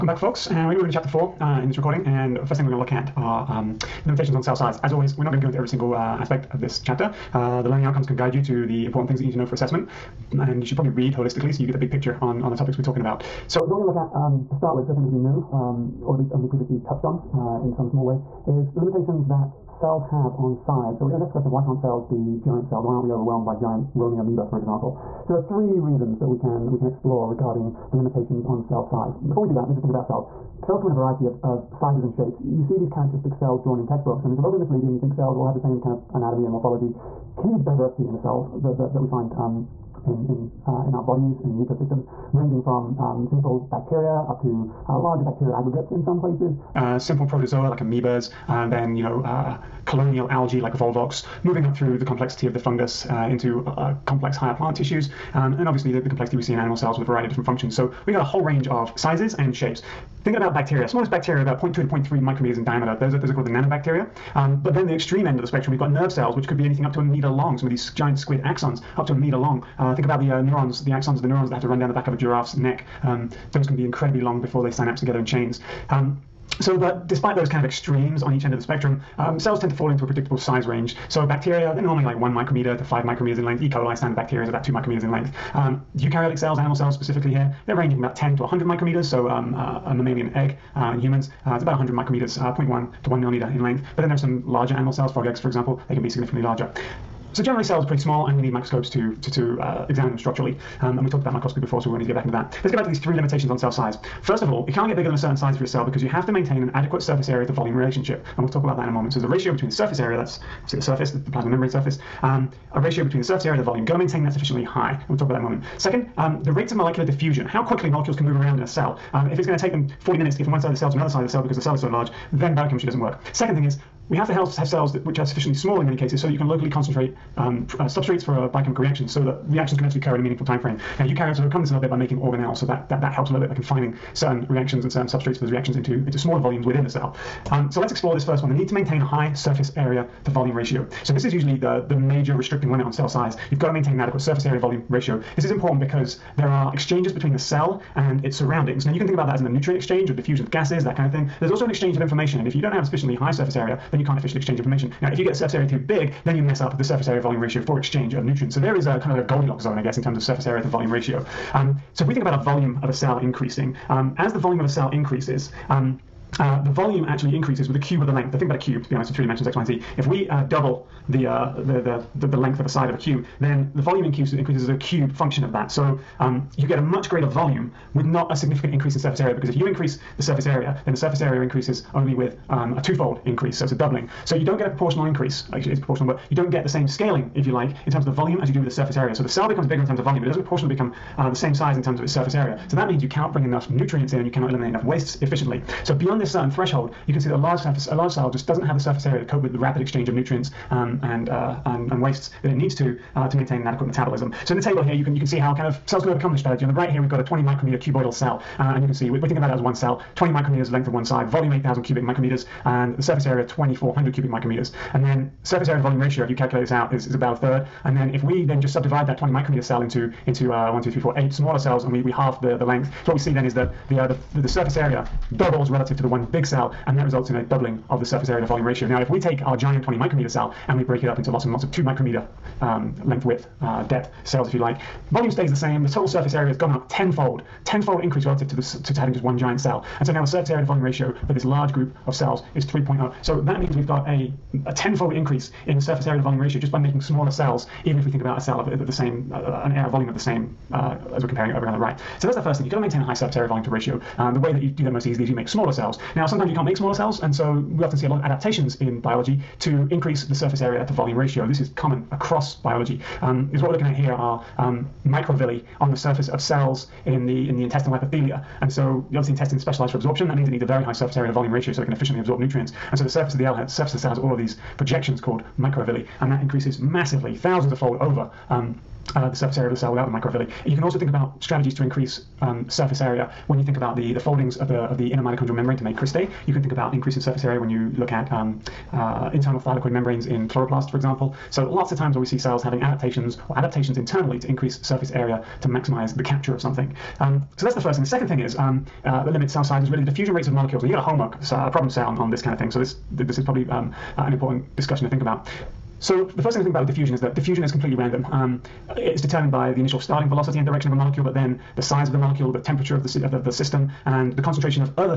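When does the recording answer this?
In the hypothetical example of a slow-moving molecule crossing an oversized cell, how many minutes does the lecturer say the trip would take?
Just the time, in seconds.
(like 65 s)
120 s.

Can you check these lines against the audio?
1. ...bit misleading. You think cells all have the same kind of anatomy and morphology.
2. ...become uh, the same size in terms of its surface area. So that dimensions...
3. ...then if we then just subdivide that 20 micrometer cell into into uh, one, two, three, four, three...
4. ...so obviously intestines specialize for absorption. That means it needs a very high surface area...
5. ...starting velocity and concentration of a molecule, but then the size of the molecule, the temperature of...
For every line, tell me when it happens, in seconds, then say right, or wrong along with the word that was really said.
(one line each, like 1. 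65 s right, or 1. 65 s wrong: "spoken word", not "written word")
1. 34 s right
2. 190 s wrong: "means", not "dimensions"
3. 217 s wrong: "eight", not "three"
4. 268 s right
5. 309 s wrong: "direction", not "concentration".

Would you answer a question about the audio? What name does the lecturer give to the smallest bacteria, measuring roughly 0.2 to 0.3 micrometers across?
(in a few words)
nanobacteria.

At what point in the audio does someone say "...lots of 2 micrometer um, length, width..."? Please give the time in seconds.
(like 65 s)
231 s.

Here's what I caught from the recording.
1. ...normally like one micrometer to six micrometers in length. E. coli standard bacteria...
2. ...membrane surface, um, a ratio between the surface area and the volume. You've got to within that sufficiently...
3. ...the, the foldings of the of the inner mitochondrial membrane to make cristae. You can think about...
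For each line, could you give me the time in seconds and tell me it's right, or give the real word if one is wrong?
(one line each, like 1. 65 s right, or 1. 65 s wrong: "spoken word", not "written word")
1. 81 s wrong: "five", not "six"
2. 111 s wrong: "maintain", not "within"
3. 283 s right.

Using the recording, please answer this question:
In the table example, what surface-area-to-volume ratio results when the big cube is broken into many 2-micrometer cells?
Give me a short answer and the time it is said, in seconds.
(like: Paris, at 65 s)
3.0, at 242 s.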